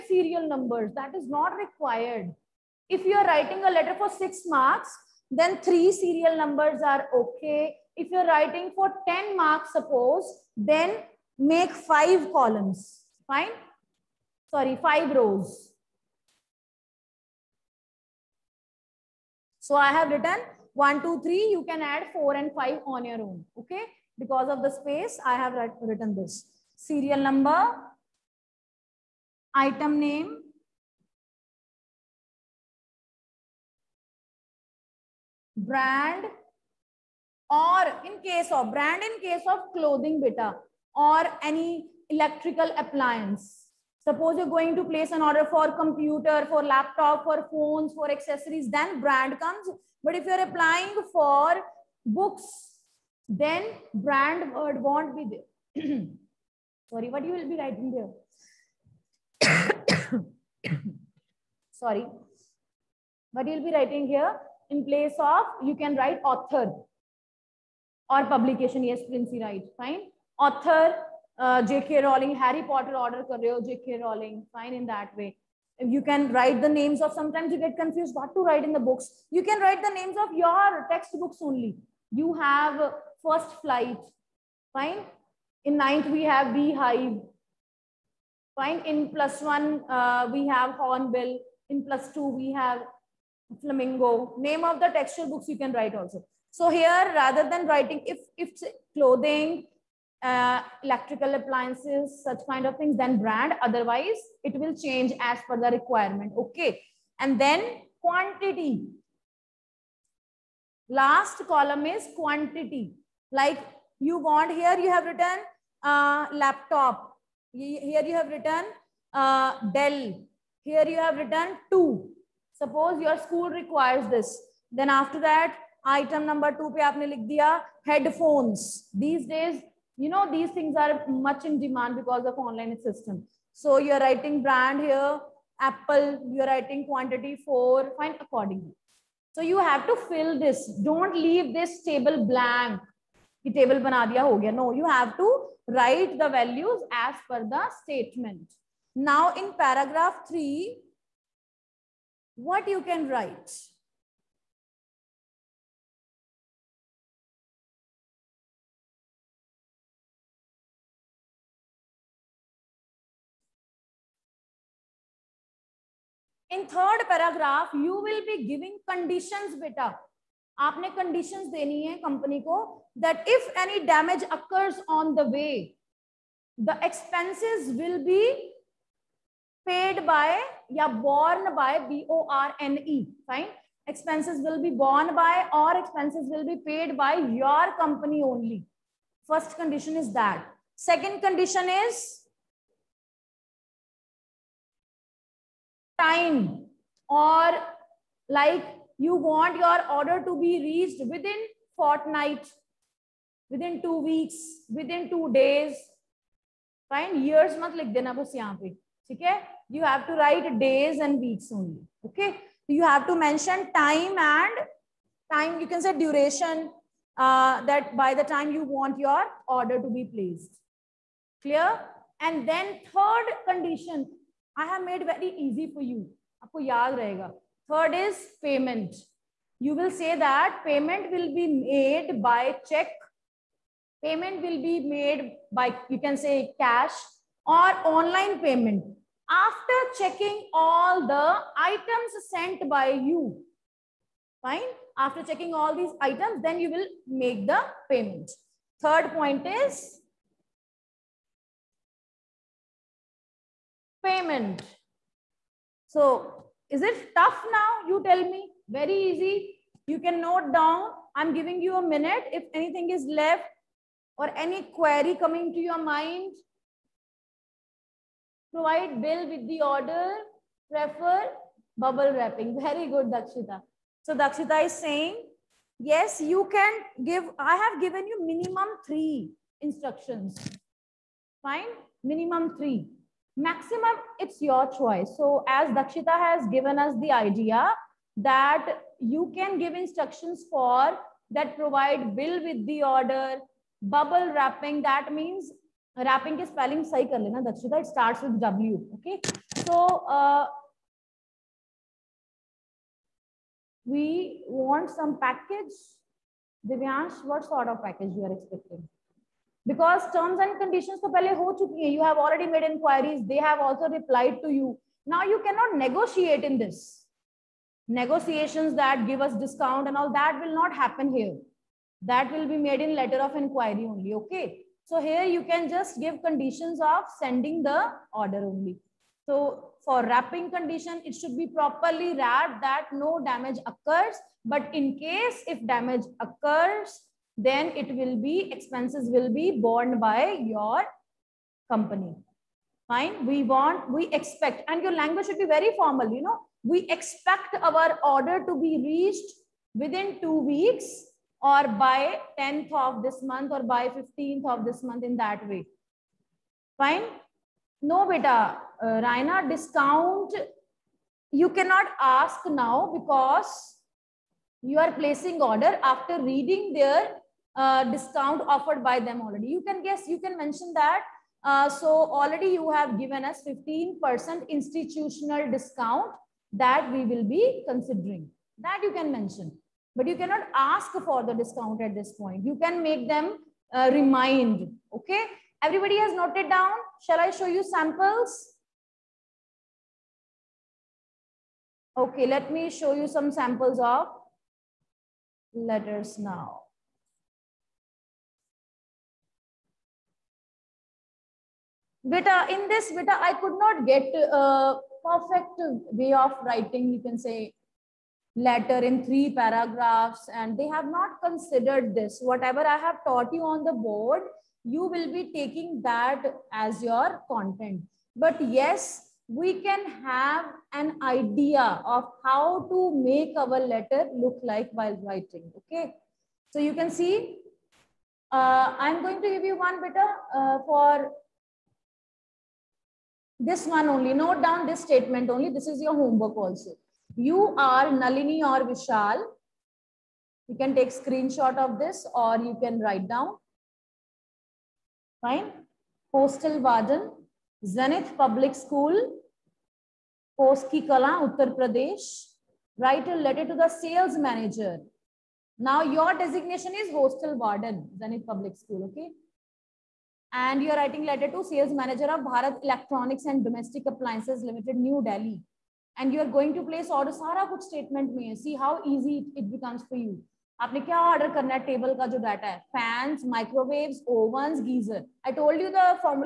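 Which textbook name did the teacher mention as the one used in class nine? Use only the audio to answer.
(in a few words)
Beehive.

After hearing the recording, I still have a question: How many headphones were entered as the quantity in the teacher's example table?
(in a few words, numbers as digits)
4.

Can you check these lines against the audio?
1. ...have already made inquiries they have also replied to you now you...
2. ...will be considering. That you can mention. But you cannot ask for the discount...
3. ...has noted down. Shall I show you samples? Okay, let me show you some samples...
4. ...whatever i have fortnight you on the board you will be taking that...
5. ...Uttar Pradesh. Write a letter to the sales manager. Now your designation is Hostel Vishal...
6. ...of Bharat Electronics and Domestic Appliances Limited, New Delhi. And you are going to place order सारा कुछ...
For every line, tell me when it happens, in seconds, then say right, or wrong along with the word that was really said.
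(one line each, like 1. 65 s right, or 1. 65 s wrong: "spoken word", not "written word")
1. 312 s right
2. 377 s right
3. 385 s right
4. 412 s wrong: "taught", not "fortnight"
5. 451 s wrong: "Warden", not "Vishal"
6. 462 s right.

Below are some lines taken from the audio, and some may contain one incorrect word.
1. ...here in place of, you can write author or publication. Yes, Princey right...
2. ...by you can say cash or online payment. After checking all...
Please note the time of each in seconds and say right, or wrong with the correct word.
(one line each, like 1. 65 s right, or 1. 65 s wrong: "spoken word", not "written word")
1. 64 s right
2. 235 s right.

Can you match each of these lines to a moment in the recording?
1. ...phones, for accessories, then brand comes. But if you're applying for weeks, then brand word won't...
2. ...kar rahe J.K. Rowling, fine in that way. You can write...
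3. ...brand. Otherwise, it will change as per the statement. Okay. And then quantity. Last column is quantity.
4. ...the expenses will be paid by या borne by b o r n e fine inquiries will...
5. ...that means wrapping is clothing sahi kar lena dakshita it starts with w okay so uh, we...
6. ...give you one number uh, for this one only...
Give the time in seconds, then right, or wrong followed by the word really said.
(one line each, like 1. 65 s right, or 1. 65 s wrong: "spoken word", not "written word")
1. 47 s wrong: "books", not "weeks"
2. 73 s right
3. 103 s wrong: "requirement", not "statement"
4. 176 s wrong: "expenses", not "inquiries"
5. 294 s wrong: "spelling", not "clothing"
6. 429 s wrong: "better", not "number".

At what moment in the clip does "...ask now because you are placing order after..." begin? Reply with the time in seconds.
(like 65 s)
362 s.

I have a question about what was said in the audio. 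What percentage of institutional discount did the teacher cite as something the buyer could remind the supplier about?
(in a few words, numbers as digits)
15%.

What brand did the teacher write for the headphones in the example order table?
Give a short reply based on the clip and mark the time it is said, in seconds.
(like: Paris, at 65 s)
Apple, at 135 s.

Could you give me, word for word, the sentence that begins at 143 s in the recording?
The table bana diya ho gaya.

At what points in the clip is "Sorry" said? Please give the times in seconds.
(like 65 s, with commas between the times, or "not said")
14 s, 56 s, 61 s.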